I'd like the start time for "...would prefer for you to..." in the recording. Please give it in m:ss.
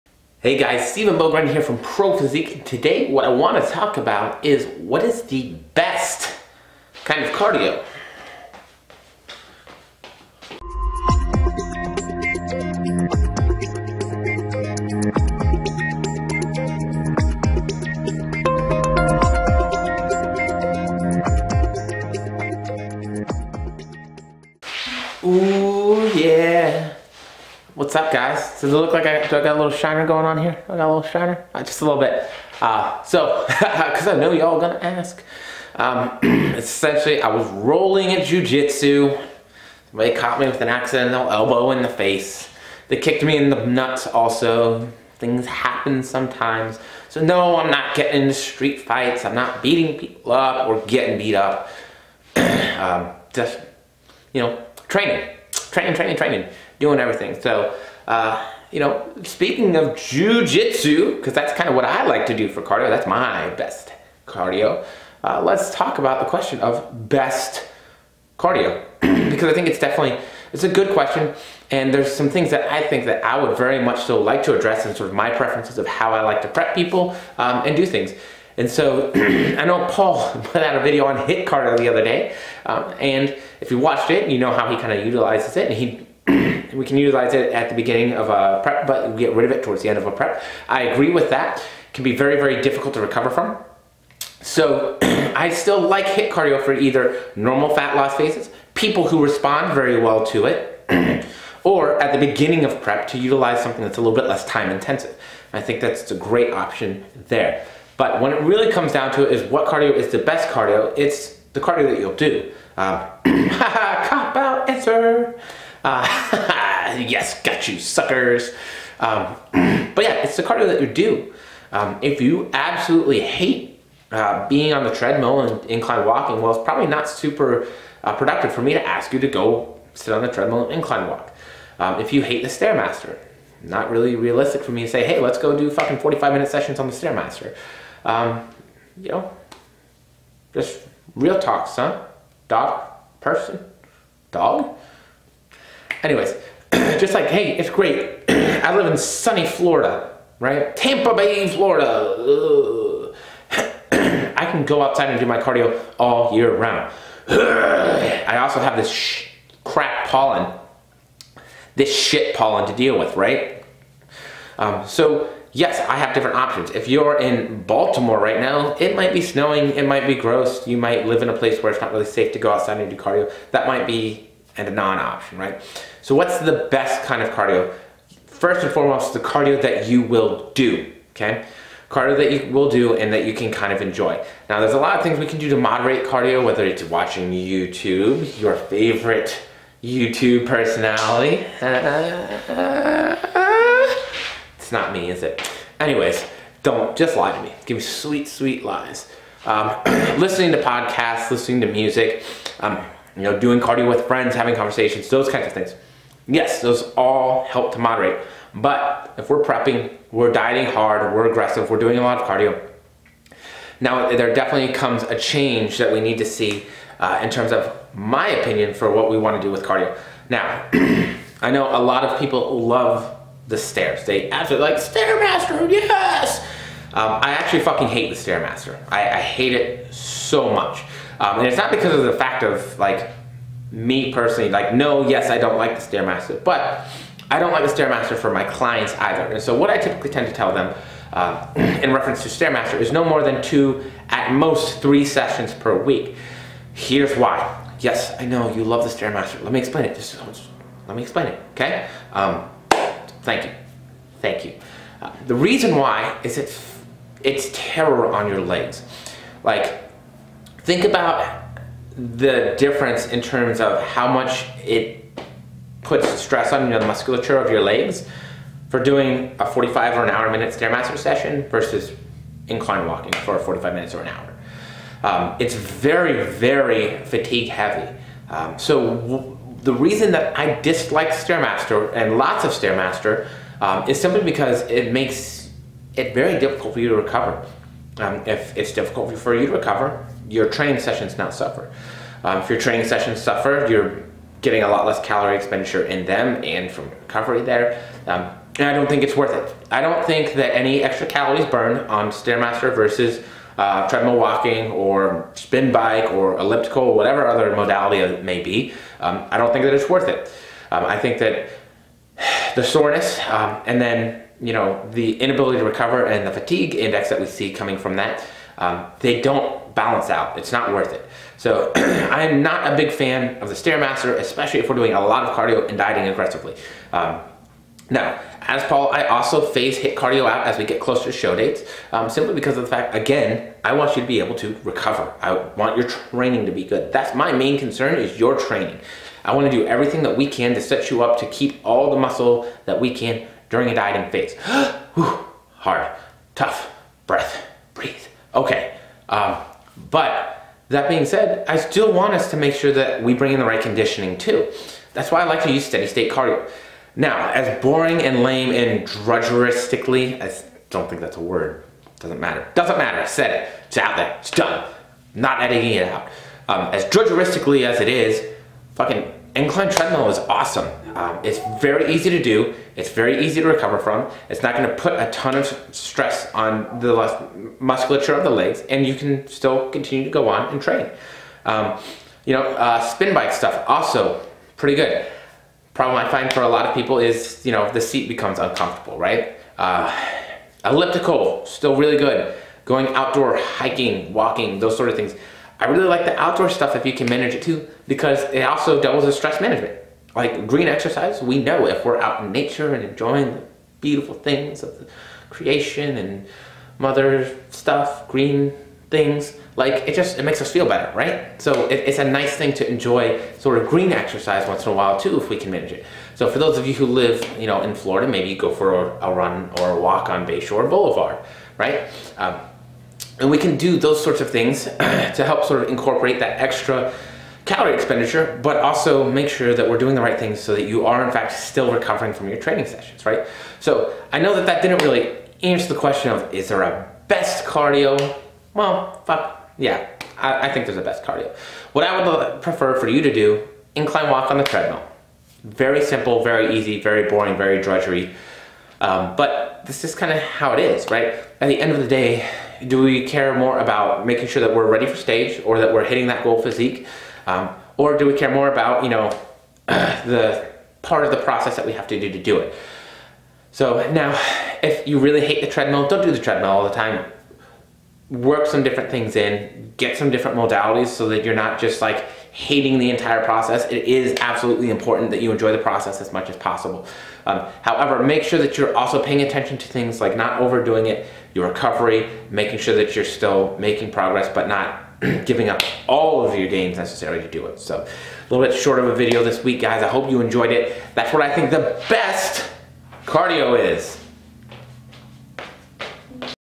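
7:22.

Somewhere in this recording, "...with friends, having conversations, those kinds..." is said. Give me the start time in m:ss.
3:23.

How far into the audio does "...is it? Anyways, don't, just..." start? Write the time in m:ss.
3:15.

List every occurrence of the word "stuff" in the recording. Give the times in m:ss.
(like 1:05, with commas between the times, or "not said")
6:23, 6:36, 6:47.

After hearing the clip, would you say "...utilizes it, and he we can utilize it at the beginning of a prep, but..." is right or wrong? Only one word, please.
right.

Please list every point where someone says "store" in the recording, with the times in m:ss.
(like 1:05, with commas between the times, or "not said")
not said.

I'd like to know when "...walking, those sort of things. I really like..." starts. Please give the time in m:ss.
6:34.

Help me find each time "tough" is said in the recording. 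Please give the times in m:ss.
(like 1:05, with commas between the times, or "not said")
5:46.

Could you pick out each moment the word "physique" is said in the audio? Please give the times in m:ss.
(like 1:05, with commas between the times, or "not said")
0:02, 7:36.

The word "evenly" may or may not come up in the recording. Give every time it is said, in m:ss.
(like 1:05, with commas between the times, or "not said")
not said.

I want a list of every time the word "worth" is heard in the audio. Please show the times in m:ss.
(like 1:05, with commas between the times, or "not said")
4:59, 5:09, 5:20.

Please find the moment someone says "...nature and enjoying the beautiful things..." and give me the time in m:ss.
6:42.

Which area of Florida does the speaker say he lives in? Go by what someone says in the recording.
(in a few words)
Tampa Bay.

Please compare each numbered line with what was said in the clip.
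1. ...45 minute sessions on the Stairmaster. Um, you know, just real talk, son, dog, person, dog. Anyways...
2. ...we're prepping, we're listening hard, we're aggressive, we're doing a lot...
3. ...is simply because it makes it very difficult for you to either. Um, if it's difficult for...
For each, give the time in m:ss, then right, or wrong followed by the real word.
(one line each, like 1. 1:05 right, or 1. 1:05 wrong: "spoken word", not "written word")
1. 2:15 right
2. 3:29 wrong: "dieting", not "listening"
3. 4:43 wrong: "recover", not "either".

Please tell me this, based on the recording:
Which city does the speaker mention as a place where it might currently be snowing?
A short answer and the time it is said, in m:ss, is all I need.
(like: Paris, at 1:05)
Baltimore, at 2:47.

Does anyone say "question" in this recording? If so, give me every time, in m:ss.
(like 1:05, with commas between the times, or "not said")
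1:06, 1:10, 7:15.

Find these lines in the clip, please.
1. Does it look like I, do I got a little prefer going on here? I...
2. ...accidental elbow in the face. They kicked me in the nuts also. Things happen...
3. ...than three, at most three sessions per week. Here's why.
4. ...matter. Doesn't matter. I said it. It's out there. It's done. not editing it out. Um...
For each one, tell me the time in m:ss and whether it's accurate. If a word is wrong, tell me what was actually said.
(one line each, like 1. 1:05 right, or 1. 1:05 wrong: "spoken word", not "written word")
1. 0:28 wrong: "shiner", not "prefer"
2. 0:40 right
3. 4:03 wrong: "two", not "three"
4. 6:02 right.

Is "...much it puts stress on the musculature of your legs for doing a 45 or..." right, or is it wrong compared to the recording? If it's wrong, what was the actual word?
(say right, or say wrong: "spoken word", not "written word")
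right.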